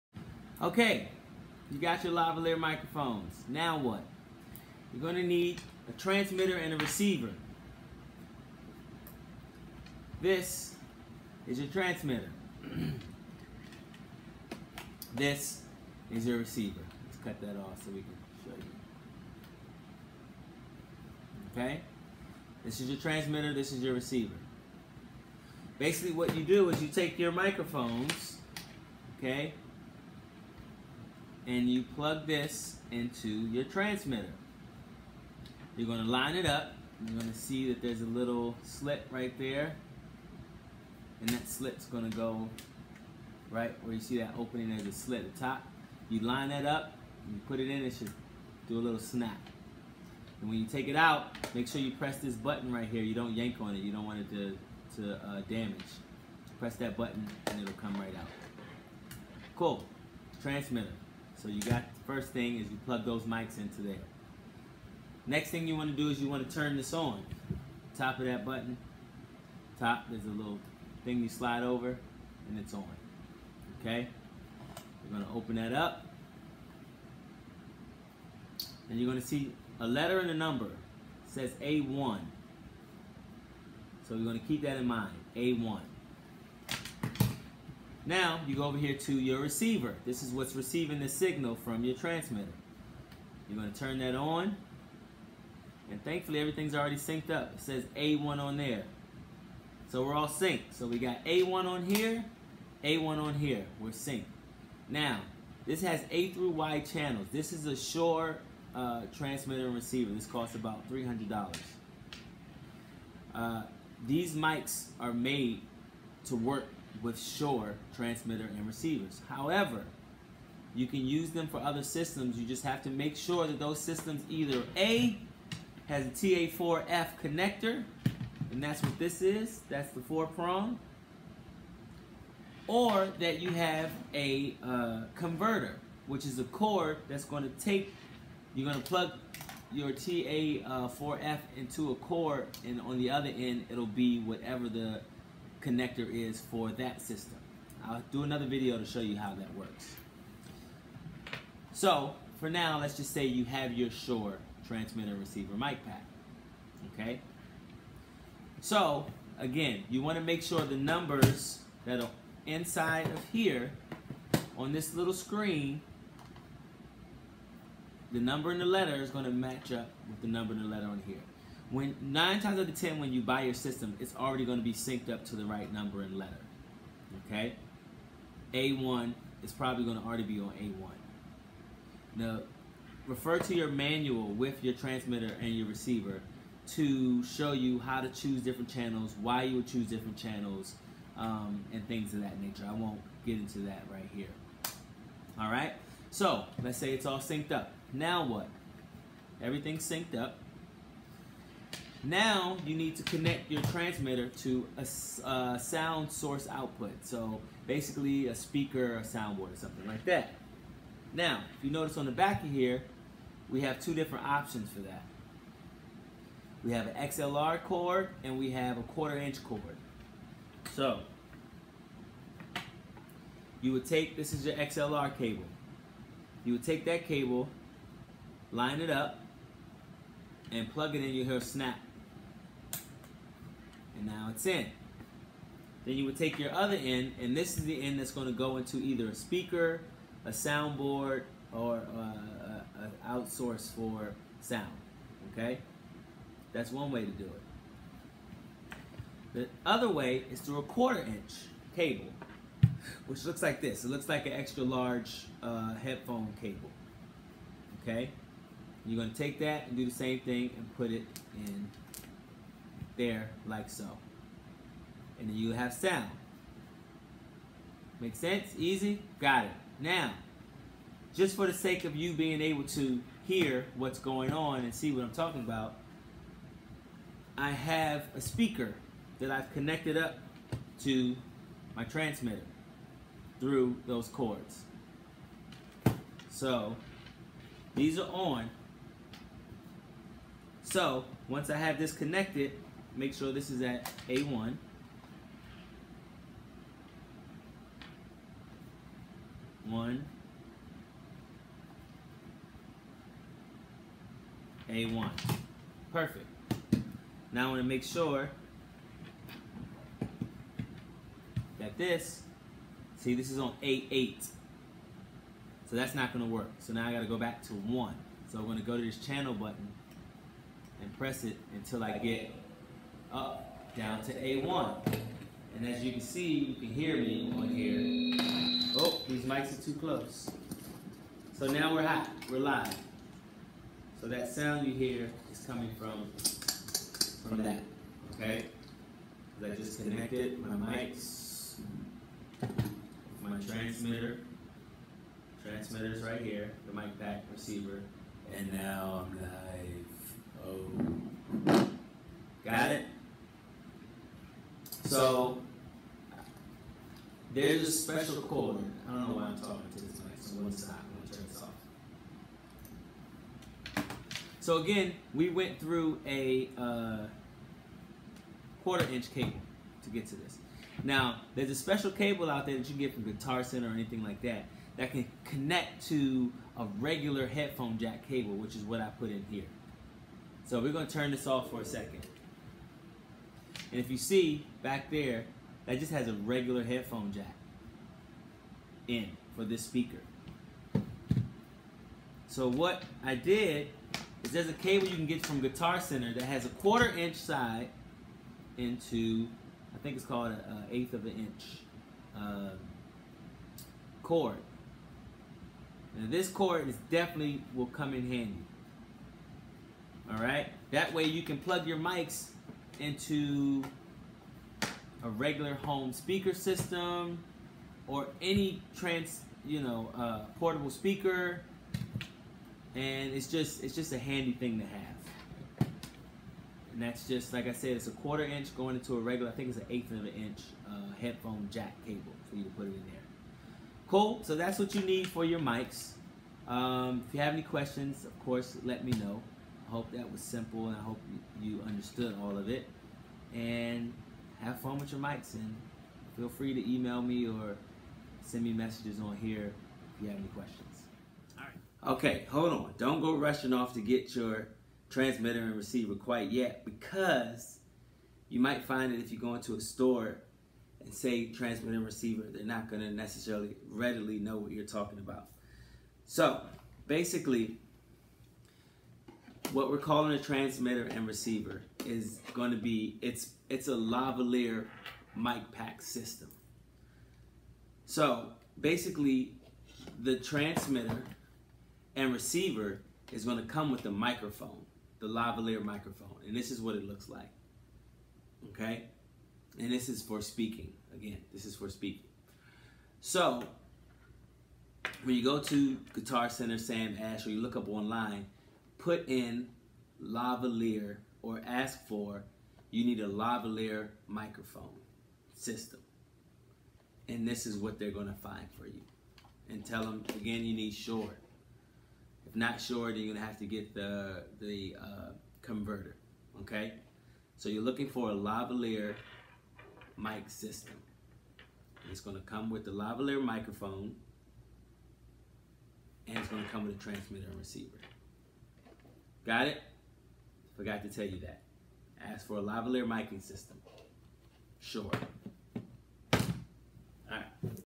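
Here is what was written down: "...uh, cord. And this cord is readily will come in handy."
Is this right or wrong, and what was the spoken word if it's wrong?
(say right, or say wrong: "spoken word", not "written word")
wrong: "definitely", not "readily".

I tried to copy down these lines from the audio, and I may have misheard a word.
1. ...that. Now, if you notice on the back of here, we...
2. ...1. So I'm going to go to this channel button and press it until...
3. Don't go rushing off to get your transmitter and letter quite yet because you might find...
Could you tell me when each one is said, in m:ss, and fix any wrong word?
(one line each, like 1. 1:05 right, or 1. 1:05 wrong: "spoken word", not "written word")
1. 3:30 right
2. 5:17 right
3. 7:32 wrong: "receiver", not "letter".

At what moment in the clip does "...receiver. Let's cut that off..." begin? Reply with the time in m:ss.
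0:16.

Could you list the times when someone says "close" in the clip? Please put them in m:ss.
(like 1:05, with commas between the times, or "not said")
5:29.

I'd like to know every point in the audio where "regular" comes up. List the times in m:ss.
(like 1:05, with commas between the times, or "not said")
6:16, 6:26, 6:55, 7:08.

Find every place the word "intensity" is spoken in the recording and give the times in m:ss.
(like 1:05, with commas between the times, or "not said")
not said.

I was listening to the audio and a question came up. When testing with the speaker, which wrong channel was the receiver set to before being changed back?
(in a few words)
A8.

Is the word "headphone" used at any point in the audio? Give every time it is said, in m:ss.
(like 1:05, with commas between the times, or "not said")
4:15, 6:17, 6:26, 7:10.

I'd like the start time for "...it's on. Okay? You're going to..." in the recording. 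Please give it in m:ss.
1:12.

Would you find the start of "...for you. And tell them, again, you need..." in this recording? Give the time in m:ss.
8:28.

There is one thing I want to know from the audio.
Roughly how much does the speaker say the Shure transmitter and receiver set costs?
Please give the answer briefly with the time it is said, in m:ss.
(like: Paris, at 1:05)
$300, at 1:50.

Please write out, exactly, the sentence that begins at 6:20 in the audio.
So we're gonna turn this off for a second.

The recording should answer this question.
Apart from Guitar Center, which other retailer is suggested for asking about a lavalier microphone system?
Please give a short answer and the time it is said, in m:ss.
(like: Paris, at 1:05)
Sam Ash, at 8:16.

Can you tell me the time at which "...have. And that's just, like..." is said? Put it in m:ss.
7:04.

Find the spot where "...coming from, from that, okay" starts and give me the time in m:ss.
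5:35.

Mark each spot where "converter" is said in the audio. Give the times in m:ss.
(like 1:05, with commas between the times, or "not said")
2:15, 8:35.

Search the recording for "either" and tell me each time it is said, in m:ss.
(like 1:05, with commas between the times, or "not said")
2:04, 3:58.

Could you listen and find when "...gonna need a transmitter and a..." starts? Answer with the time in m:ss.
0:05.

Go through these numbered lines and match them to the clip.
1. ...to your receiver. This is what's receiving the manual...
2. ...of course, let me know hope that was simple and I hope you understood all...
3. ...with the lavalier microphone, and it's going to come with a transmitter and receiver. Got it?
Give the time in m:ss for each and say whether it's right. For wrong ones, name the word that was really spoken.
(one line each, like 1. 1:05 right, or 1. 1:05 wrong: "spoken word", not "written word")
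1. 1:28 wrong: "signal", not "manual"
2. 7:18 right
3. 8:42 right.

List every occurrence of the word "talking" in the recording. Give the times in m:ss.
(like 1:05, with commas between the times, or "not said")
4:35, 5:59, 7:44.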